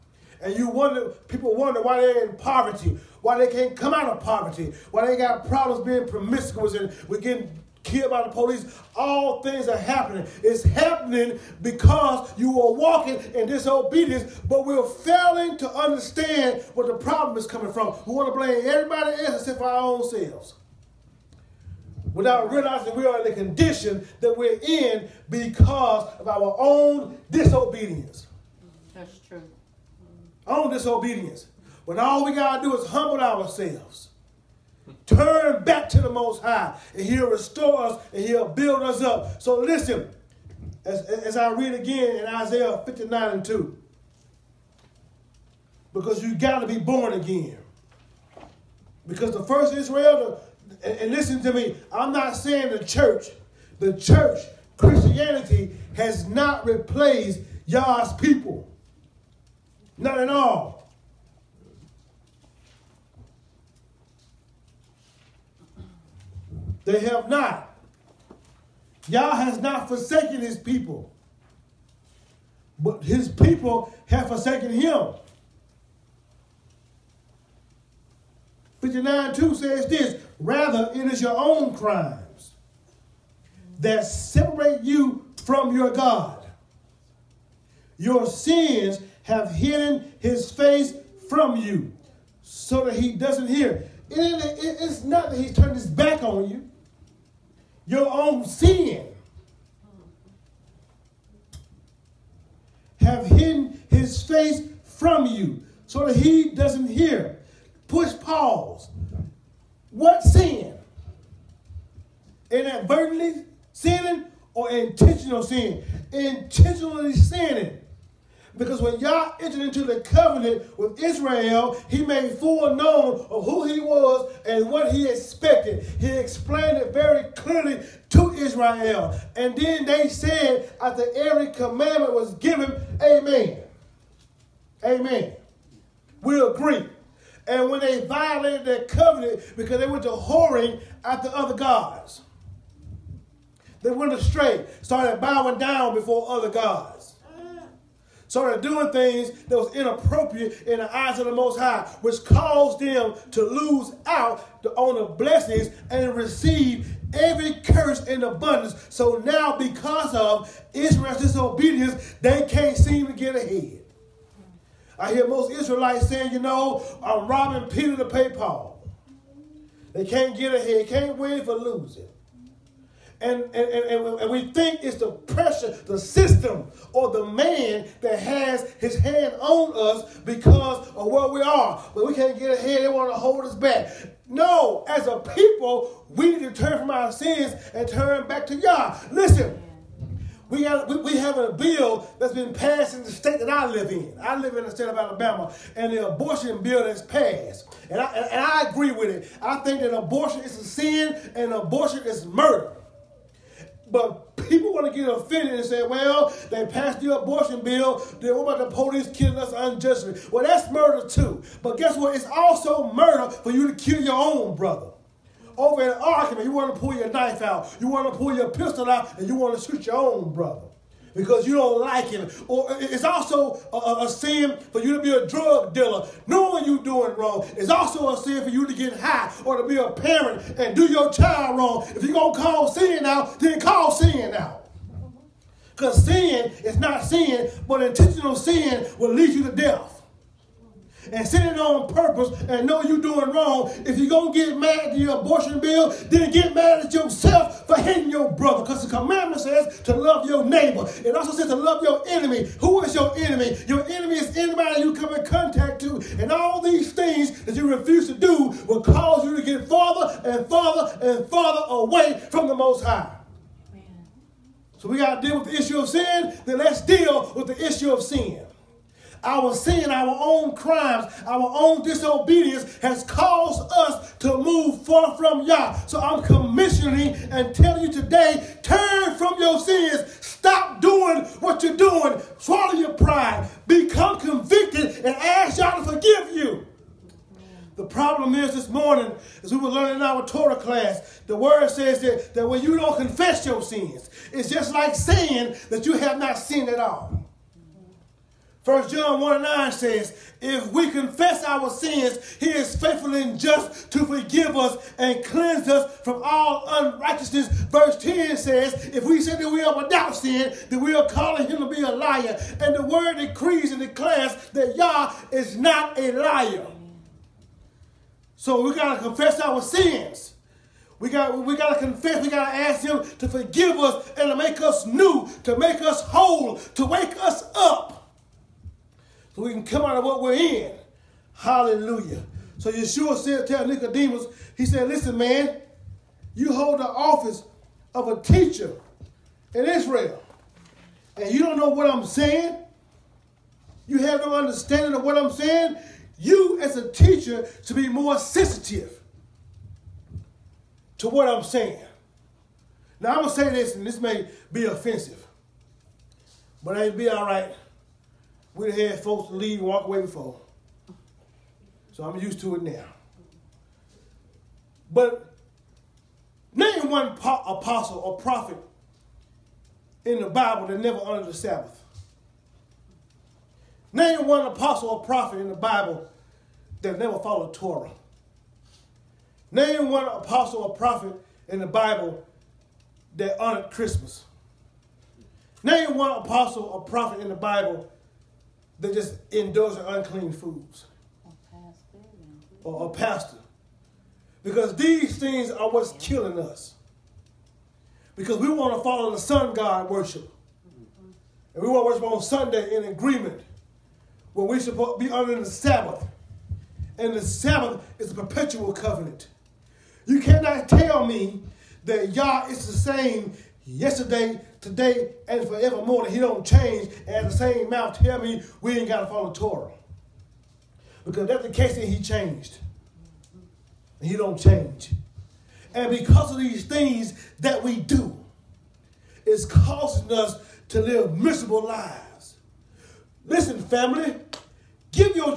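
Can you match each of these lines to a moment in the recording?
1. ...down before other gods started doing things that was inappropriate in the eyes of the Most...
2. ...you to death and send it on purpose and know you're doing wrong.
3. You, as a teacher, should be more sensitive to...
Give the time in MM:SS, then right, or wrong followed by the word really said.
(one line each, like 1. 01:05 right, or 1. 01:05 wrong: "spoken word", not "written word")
1. 02:25 right
2. 03:59 right
3. 05:46 right.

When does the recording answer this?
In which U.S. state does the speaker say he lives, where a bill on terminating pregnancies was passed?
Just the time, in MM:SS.
03:14.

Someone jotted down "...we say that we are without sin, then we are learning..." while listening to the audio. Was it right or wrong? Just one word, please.
wrong.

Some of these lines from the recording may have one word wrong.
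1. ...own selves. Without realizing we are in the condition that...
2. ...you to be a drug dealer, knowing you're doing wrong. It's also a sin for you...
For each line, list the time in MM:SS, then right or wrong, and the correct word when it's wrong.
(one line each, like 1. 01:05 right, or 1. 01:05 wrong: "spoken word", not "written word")
1. 00:19 right
2. 03:44 right.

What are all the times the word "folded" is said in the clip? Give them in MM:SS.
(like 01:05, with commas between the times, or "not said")
not said.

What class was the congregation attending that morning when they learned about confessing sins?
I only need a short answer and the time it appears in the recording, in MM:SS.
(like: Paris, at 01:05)
Torah class, at 04:50.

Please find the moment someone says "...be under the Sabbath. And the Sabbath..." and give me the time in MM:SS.
06:44.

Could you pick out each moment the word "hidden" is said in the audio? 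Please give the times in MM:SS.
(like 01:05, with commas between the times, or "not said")
01:29, 01:43.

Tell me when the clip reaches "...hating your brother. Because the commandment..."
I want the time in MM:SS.
04:07.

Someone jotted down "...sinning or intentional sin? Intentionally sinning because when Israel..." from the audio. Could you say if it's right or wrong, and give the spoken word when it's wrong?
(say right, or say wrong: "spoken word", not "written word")
wrong: "Yah", not "Israel".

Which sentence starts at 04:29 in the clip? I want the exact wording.
Our sin, our own crimes, our own disobedience has caused us to move far from Yah.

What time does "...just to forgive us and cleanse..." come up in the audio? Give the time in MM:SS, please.
05:03.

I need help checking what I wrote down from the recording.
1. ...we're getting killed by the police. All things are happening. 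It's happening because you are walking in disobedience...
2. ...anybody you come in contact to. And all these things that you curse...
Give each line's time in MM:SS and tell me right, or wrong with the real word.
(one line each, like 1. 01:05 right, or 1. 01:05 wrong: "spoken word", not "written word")
1. 00:07 right
2. 04:14 wrong: "refuse", not "curse".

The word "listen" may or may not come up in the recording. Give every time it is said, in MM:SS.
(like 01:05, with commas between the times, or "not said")
00:39, 00:51, 03:09, 05:34, 07:13.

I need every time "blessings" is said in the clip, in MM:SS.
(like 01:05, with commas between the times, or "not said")
02:35.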